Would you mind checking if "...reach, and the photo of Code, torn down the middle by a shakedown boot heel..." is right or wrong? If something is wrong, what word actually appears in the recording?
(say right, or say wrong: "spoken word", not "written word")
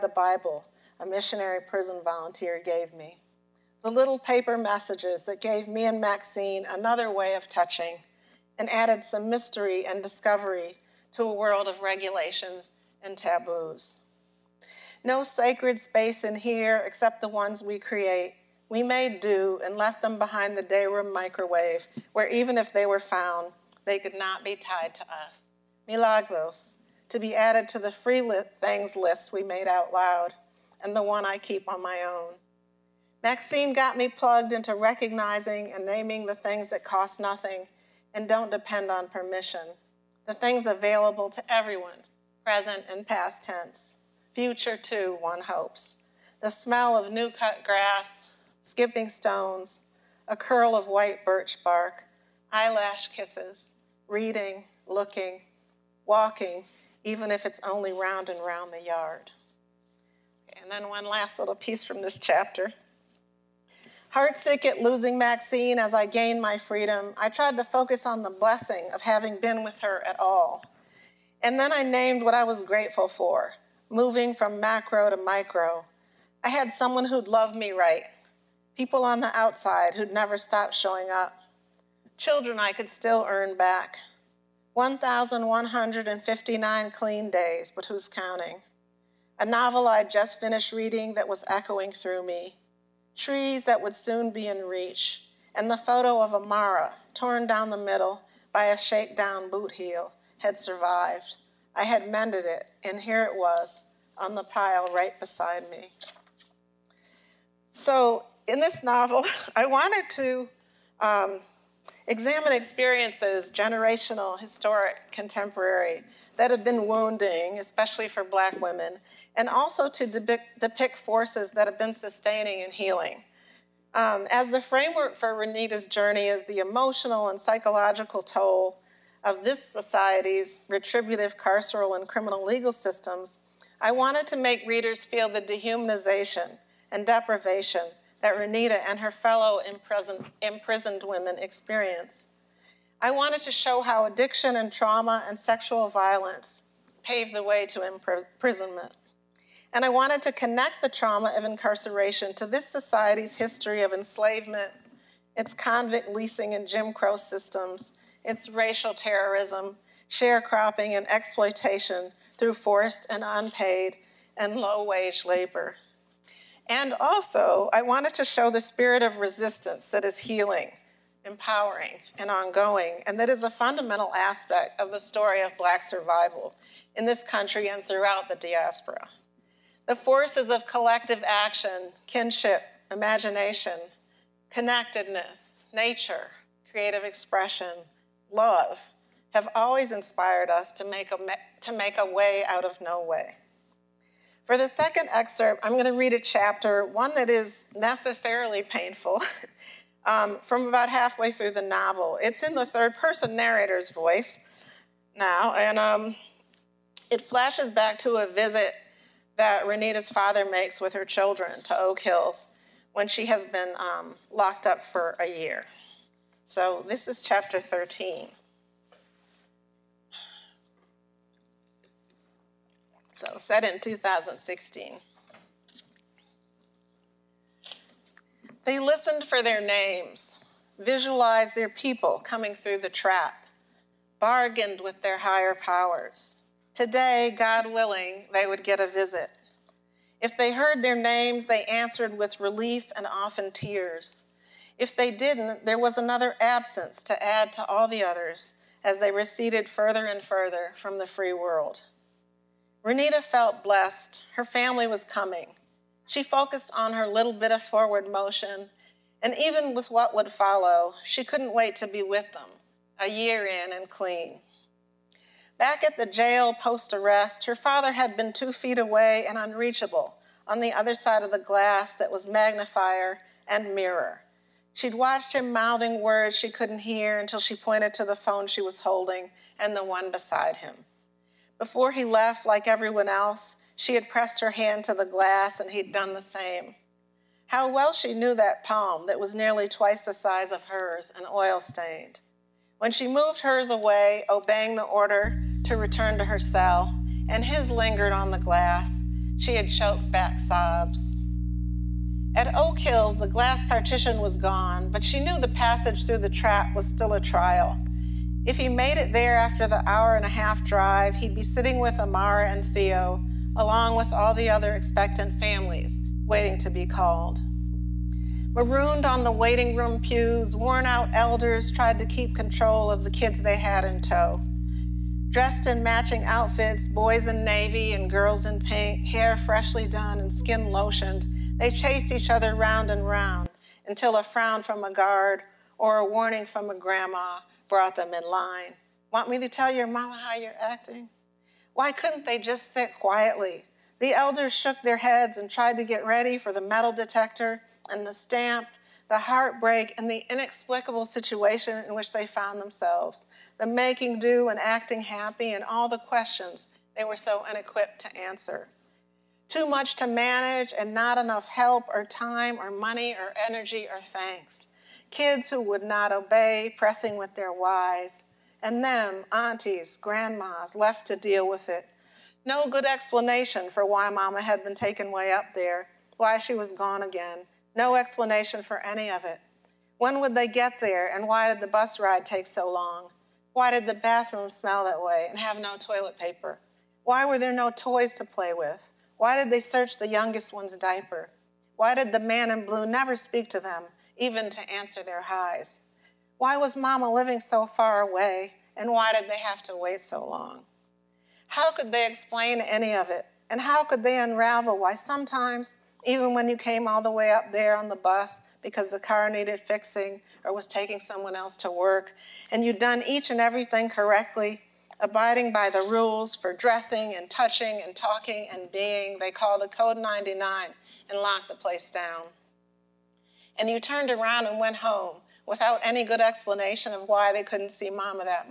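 wrong: "Amara", not "Code".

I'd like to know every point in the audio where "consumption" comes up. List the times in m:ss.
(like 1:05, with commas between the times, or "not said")
not said.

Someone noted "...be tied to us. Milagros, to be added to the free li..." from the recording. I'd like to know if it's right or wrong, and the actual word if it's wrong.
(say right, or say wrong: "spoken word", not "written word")
right.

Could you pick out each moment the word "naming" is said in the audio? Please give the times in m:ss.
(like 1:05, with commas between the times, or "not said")
0:35.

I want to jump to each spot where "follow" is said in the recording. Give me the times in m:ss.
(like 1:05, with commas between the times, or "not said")
4:20.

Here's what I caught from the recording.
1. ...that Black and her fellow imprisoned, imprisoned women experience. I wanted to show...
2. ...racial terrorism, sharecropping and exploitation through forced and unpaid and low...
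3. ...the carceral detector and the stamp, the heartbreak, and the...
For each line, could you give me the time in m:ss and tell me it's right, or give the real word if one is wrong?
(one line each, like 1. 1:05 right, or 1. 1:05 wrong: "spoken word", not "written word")
1. 2:18 wrong: "Renita", not "Black"
2. 2:38 right
3. 5:46 wrong: "metal", not "carceral".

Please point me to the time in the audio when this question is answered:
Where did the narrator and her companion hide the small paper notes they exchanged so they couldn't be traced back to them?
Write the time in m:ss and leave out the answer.
0:20.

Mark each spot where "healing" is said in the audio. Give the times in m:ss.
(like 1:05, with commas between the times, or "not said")
2:02, 2:50.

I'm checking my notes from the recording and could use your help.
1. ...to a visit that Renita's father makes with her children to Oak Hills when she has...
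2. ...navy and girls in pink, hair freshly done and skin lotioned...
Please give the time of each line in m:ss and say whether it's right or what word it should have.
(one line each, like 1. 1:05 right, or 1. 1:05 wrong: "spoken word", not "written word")
1. 3:27 right
2. 5:27 right.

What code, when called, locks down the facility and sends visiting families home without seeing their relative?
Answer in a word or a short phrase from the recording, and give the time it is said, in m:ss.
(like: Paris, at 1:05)
Code 99, at 6:59.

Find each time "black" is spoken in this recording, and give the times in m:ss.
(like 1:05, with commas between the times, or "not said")
1:58, 2:55.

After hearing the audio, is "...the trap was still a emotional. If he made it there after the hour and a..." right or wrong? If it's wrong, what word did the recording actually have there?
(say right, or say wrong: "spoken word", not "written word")
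wrong: "trial", not "emotional".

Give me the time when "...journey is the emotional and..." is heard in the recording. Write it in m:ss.
2:05.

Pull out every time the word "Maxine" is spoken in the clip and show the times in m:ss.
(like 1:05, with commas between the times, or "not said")
0:05, 0:33, 1:05.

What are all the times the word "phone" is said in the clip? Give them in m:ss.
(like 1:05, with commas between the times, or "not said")
4:38.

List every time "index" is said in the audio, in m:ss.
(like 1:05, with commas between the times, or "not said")
not said.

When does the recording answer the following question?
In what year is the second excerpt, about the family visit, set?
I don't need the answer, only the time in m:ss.
3:43.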